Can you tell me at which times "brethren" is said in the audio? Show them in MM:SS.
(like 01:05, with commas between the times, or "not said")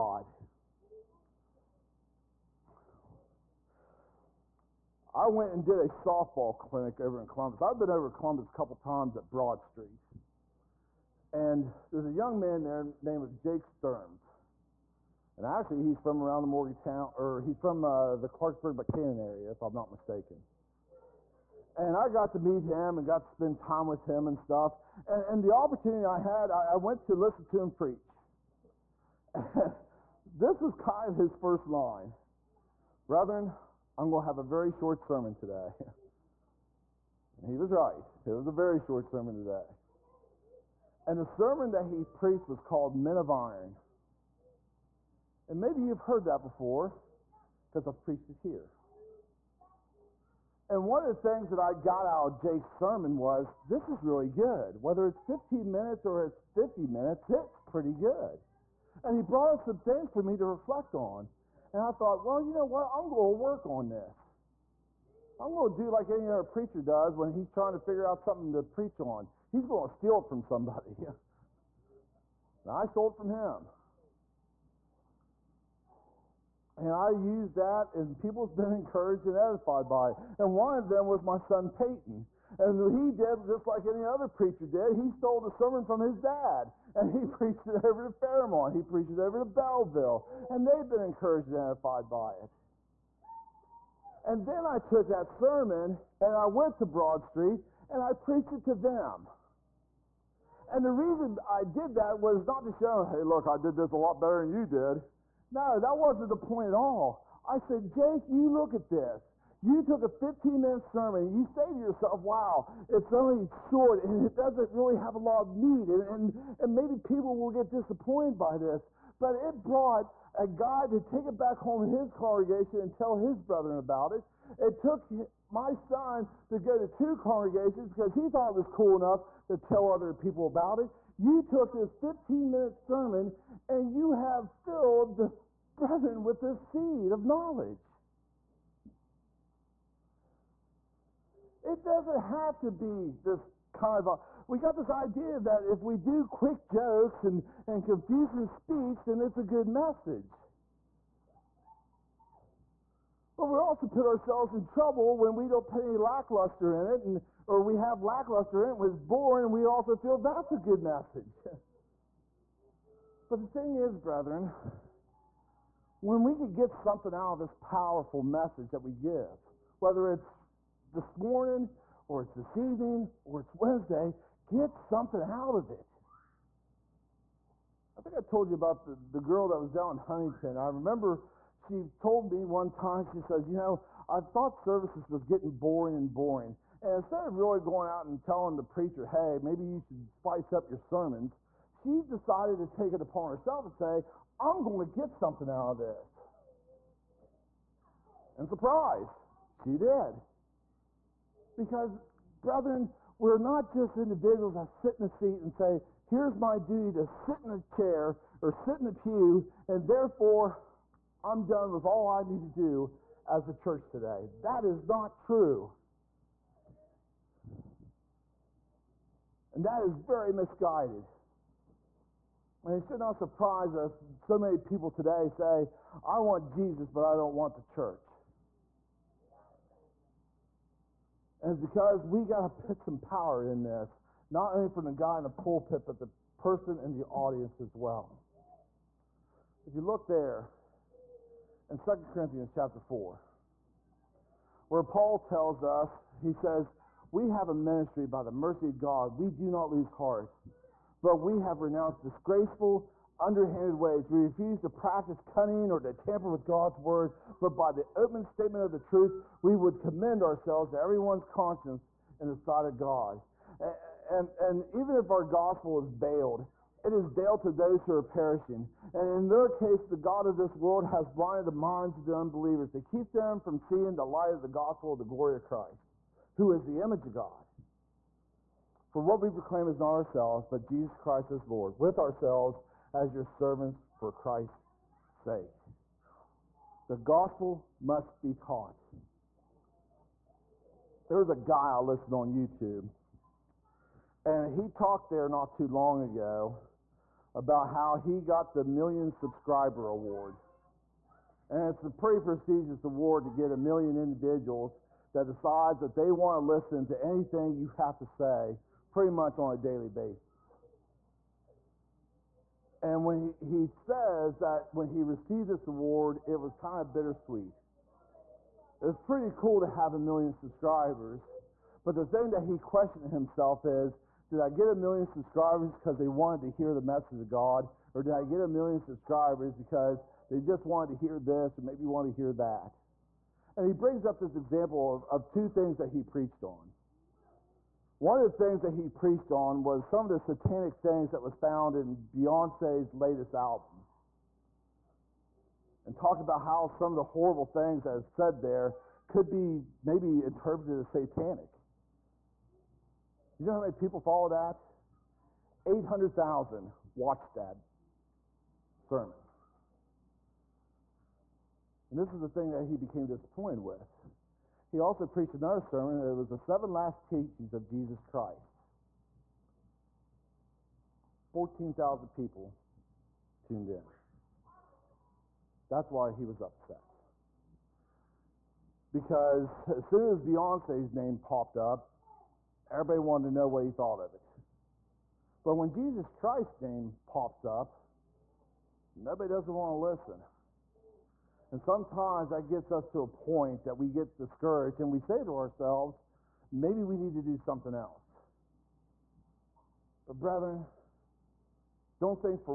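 00:33, 02:03, 02:15, 02:43, 03:22, 06:40.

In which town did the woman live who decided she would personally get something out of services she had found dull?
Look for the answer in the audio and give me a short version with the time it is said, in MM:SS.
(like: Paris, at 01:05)
Huntington, at 02:59.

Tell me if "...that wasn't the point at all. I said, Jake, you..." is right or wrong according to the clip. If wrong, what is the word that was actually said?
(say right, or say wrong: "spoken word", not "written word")
right.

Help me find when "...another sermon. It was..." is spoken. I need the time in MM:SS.
06:05.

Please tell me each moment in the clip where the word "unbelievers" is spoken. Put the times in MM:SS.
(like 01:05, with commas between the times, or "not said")
04:32.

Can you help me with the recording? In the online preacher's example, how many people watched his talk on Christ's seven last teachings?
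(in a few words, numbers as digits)
14,000.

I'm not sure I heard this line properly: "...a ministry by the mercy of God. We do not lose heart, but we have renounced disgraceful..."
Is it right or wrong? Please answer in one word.
right.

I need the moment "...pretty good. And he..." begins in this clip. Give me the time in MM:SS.
00:57.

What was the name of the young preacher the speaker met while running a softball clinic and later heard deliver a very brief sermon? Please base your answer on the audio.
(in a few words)
Jake Sturms.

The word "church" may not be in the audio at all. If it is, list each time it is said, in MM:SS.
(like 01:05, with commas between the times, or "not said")
03:33, 03:47.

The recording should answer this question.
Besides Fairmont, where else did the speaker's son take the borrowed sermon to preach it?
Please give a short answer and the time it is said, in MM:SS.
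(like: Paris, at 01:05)
Belleville, at 01:29.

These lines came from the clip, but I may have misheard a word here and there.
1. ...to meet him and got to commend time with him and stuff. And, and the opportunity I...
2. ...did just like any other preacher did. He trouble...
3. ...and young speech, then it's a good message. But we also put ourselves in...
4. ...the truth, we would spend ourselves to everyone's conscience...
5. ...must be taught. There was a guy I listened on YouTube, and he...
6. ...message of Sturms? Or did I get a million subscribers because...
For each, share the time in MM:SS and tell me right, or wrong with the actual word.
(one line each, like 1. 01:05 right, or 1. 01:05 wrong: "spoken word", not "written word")
1. 00:22 wrong: "spend", not "commend"
2. 01:23 wrong: "stole", not "trouble"
3. 02:27 wrong: "confusing", not "young"
4. 04:18 wrong: "commend", not "spend"
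5. 04:47 right
6. 05:26 wrong: "God", not "Sturms".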